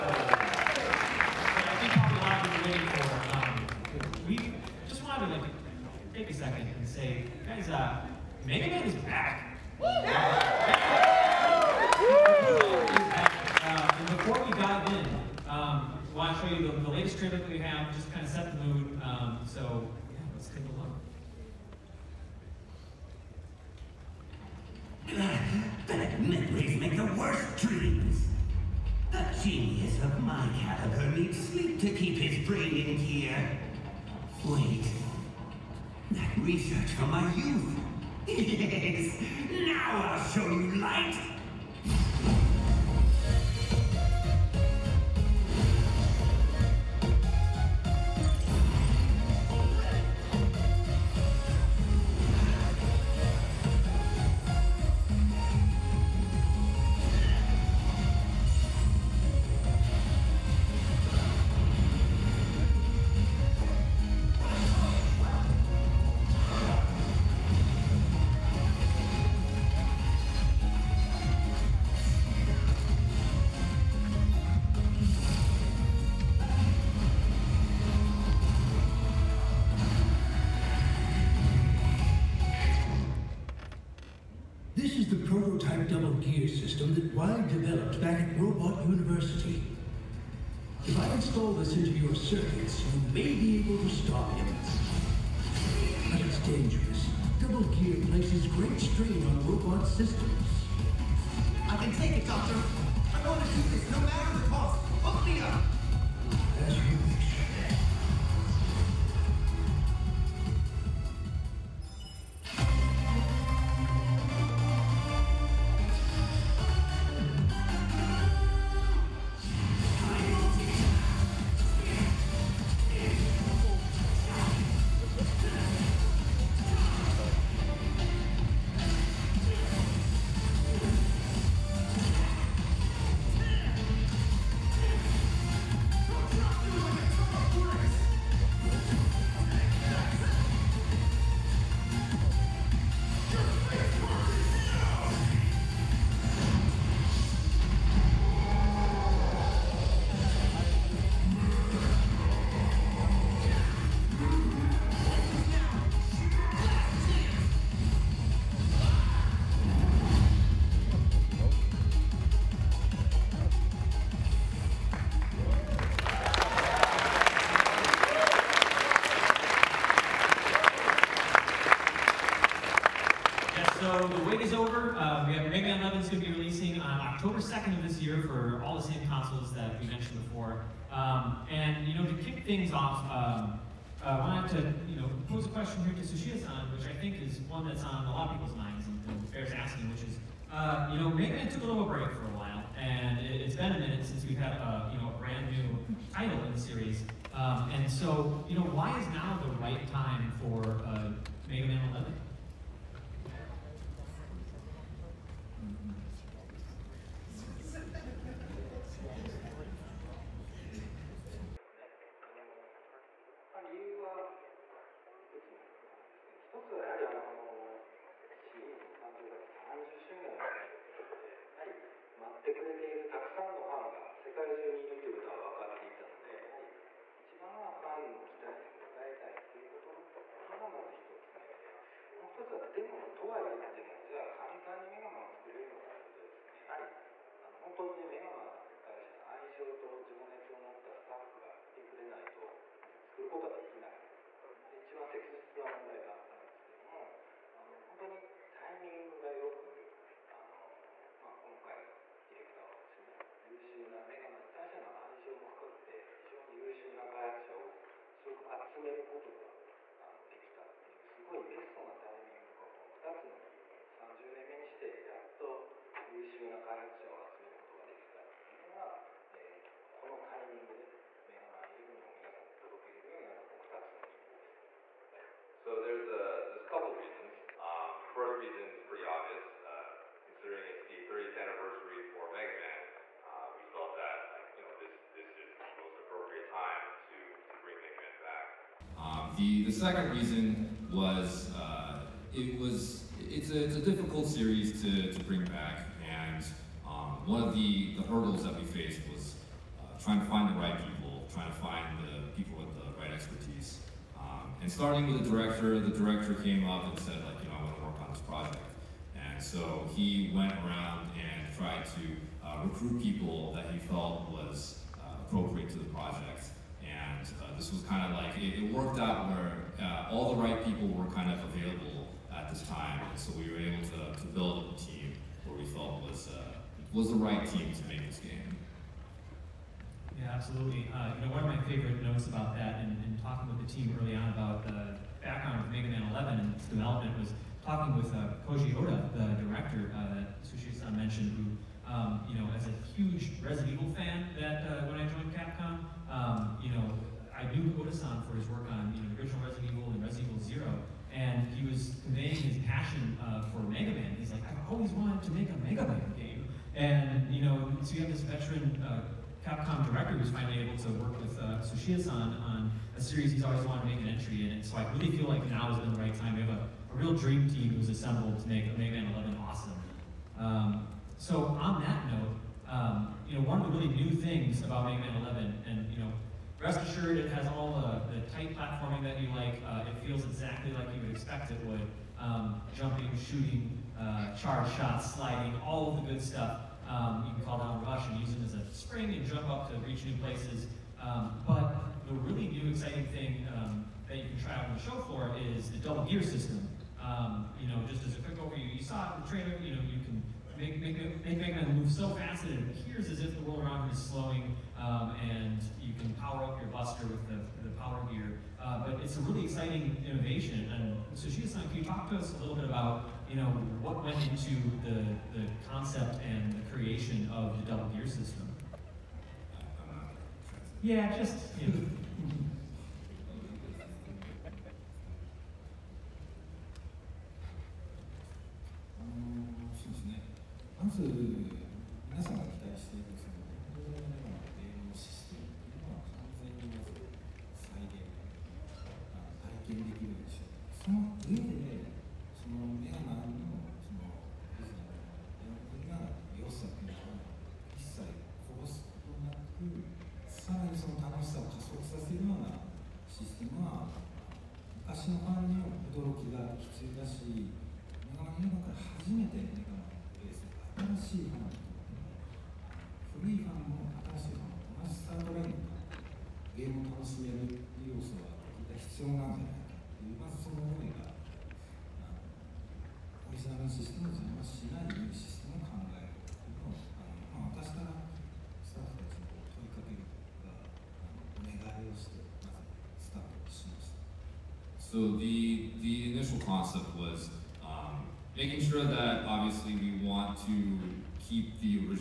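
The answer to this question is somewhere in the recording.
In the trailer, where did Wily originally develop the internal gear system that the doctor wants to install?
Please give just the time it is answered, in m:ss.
1:28.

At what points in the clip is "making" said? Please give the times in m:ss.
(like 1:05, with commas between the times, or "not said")
8:08.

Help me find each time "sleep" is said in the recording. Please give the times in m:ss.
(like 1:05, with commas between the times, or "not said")
0:31.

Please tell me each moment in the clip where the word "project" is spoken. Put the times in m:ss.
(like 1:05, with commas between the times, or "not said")
5:08, 5:15.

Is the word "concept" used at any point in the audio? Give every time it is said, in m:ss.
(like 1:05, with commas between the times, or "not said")
6:55, 8:06.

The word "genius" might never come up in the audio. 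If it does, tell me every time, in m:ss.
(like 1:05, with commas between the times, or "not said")
0:29.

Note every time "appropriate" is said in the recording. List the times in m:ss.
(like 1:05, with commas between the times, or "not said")
4:45, 5:15.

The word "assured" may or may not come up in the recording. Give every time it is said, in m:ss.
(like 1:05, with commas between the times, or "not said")
6:16.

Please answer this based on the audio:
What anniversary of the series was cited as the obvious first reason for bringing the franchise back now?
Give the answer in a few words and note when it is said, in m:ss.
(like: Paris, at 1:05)
30th anniversary, at 4:41.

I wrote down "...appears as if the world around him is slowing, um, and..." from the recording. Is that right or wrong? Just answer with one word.
right.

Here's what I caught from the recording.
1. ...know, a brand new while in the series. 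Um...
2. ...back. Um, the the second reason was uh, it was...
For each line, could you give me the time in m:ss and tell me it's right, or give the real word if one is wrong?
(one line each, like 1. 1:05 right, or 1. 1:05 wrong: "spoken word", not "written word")
1. 3:15 wrong: "title", not "while"
2. 4:48 right.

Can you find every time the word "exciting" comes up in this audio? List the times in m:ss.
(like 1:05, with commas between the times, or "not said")
6:32, 6:49.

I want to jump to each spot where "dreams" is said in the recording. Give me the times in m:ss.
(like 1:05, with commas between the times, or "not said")
0:27, 6:07.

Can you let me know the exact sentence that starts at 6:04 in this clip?
so I really feel like now is the right time.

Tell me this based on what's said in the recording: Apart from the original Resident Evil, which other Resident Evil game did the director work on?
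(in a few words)
Resident Evil Zero.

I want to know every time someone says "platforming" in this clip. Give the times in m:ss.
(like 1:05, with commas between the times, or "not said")
6:18.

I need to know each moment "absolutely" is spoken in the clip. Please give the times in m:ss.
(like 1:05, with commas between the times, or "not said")
5:30.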